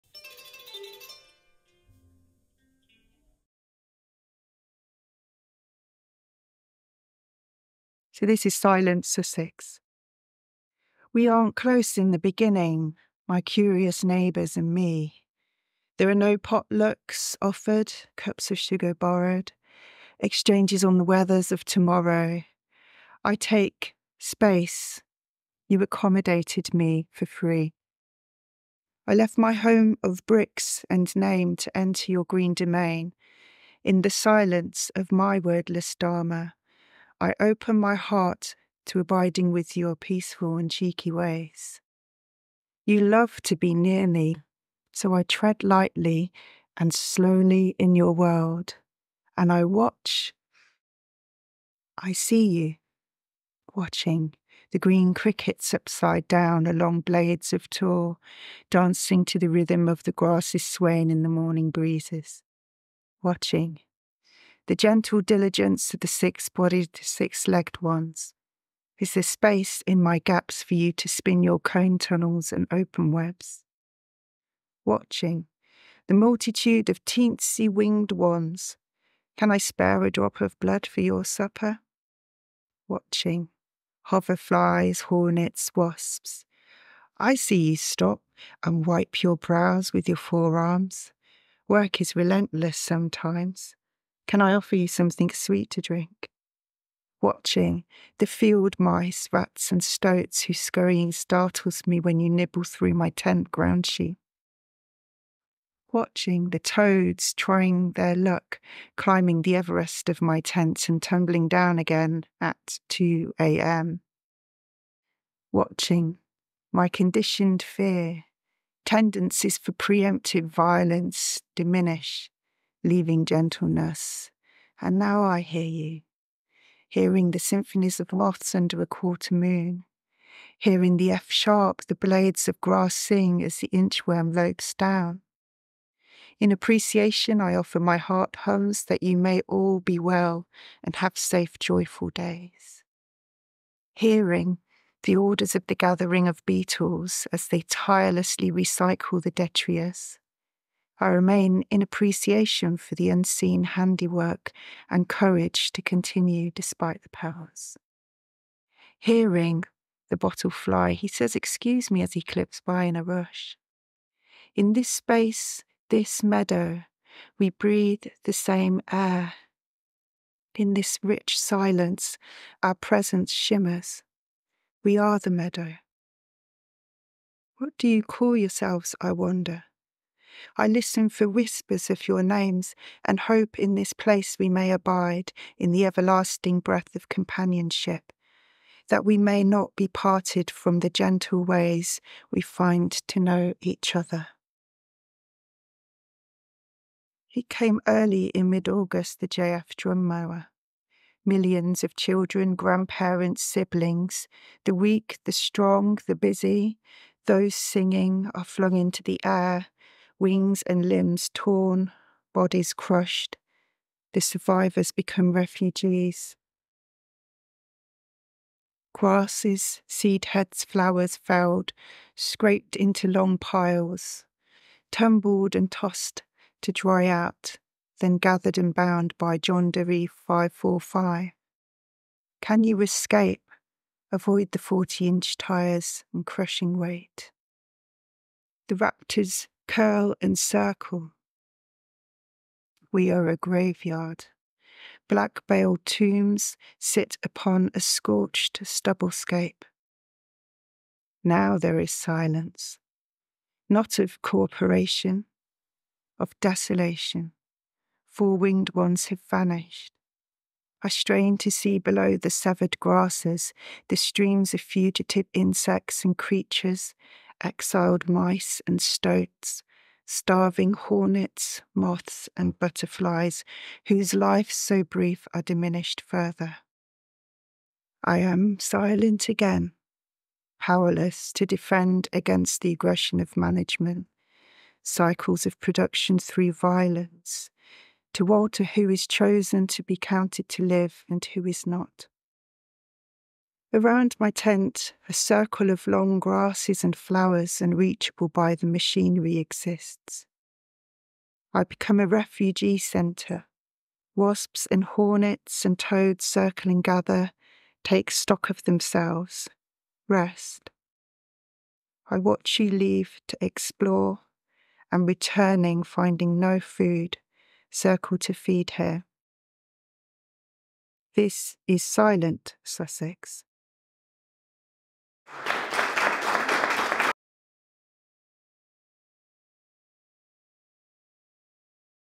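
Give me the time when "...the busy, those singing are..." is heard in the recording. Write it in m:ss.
3:26.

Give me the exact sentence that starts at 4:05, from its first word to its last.
Black bale tombs sit upon a scorched stubble scape.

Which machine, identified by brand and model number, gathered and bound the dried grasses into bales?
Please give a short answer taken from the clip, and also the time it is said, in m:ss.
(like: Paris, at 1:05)
John Deere 545, at 3:49.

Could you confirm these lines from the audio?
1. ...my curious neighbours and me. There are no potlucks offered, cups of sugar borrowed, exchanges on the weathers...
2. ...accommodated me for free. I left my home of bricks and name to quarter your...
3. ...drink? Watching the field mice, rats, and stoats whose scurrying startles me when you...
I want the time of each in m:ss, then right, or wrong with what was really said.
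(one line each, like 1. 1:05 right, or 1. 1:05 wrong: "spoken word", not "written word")
1. 0:13 right
2. 0:25 wrong: "enter", not "quarter"
3. 1:35 right.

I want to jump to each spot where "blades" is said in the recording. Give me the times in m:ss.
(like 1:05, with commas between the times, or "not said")
0:57, 2:11.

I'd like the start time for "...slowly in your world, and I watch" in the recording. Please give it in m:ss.
0:46.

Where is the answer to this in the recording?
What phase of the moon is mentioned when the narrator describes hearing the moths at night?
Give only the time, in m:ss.
2:08.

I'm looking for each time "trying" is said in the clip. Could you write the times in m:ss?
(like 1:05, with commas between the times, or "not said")
1:47.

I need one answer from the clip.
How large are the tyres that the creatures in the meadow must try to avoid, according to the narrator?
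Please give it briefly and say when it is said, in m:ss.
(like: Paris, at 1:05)
40 inch, at 3:54.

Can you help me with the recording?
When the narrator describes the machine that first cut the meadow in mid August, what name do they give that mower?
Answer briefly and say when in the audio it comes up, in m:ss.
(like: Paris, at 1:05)
JF Drummower, at 3:19.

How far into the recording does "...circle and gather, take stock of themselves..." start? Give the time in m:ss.
5:06.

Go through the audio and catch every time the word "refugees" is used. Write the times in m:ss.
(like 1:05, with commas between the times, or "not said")
3:35, 5:02.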